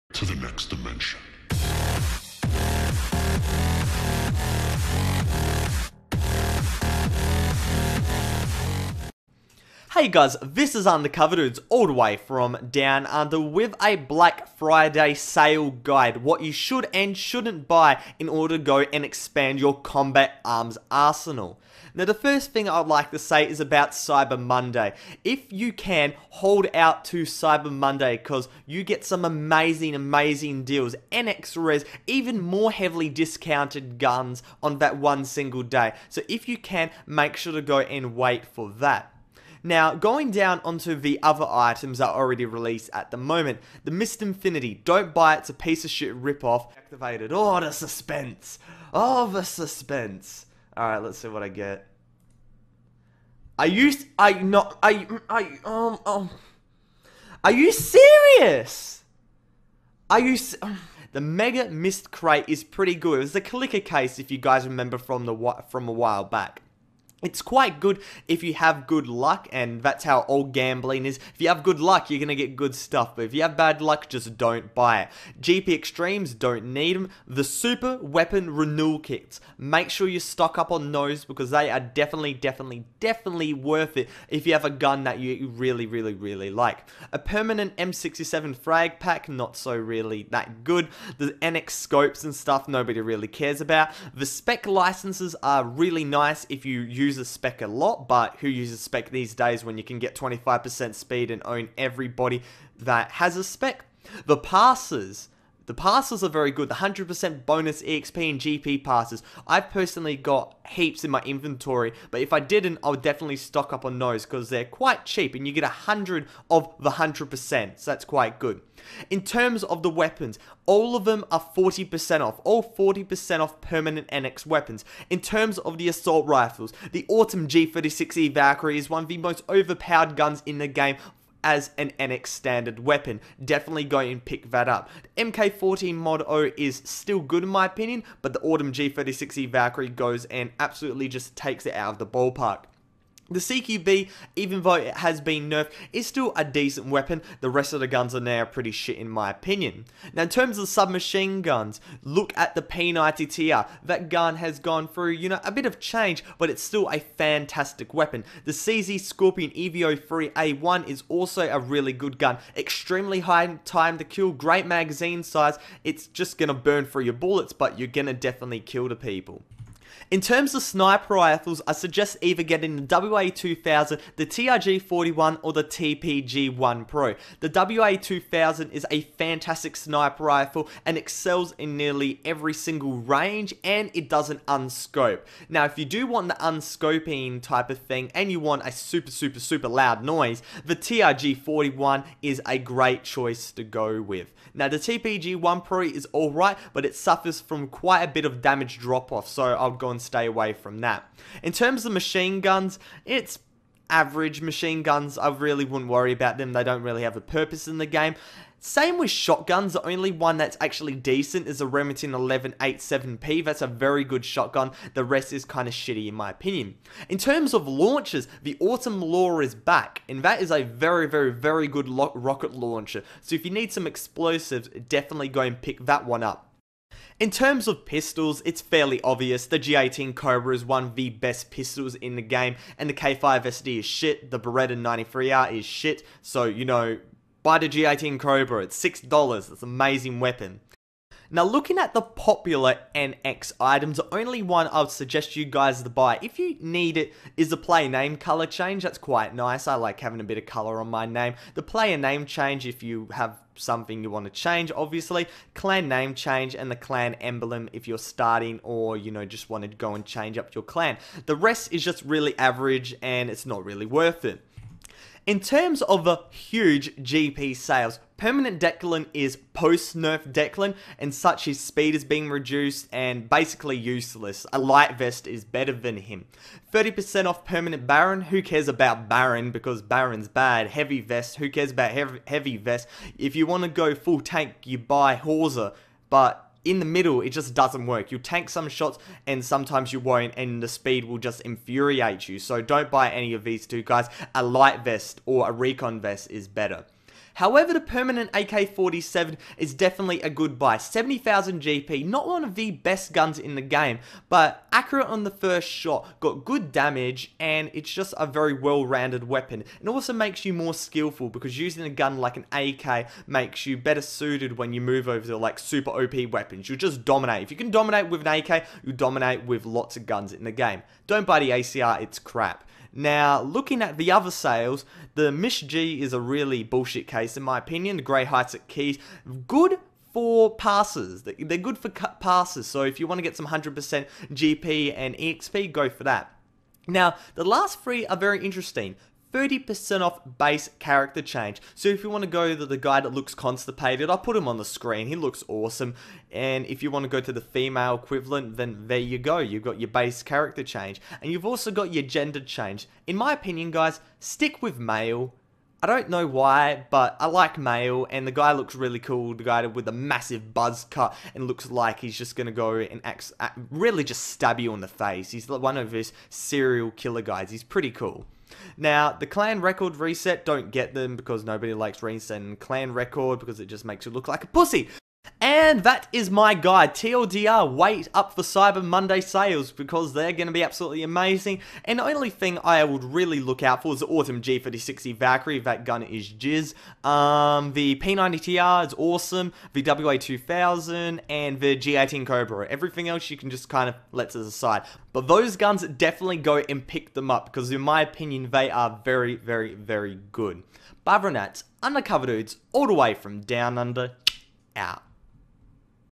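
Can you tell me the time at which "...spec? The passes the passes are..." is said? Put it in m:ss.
1:43.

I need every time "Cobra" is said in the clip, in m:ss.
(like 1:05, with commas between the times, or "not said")
3:50, 3:58, 6:32.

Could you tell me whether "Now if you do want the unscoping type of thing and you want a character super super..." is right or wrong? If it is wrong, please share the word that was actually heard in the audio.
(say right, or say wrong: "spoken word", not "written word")
wrong: "super", not "character".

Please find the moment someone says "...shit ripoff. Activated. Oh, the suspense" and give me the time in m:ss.
0:45.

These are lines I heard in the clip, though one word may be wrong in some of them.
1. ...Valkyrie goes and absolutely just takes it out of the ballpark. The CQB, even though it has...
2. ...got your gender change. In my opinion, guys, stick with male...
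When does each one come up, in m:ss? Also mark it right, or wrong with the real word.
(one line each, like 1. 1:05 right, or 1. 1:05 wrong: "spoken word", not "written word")
1. 2:19 right
2. 5:51 right.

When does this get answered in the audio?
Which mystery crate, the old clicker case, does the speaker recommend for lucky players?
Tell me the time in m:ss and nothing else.
1:01.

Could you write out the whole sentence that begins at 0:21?
Now the first thing I'd like to say is about Cyber Monday.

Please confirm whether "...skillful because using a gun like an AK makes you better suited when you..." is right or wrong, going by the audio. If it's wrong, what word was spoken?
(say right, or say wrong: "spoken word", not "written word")
right.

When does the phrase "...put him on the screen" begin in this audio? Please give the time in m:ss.
5:44.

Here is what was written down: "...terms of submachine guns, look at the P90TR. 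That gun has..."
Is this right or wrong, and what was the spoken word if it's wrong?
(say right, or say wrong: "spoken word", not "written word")
right.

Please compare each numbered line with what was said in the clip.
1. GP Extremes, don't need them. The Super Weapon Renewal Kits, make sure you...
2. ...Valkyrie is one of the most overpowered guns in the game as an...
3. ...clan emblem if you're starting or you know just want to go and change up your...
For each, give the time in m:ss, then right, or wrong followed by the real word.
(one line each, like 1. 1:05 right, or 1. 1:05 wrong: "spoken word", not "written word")
1. 1:15 right
2. 2:08 right
3. 4:16 right.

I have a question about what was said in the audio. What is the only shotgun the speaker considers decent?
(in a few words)
Remington 1187P.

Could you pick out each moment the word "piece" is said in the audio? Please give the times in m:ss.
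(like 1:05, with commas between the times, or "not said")
0:45.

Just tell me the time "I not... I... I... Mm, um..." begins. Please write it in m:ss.
0:54.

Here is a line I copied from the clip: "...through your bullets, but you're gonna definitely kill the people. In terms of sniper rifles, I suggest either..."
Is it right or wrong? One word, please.
right.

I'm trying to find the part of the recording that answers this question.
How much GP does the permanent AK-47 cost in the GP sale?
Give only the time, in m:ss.
5:00.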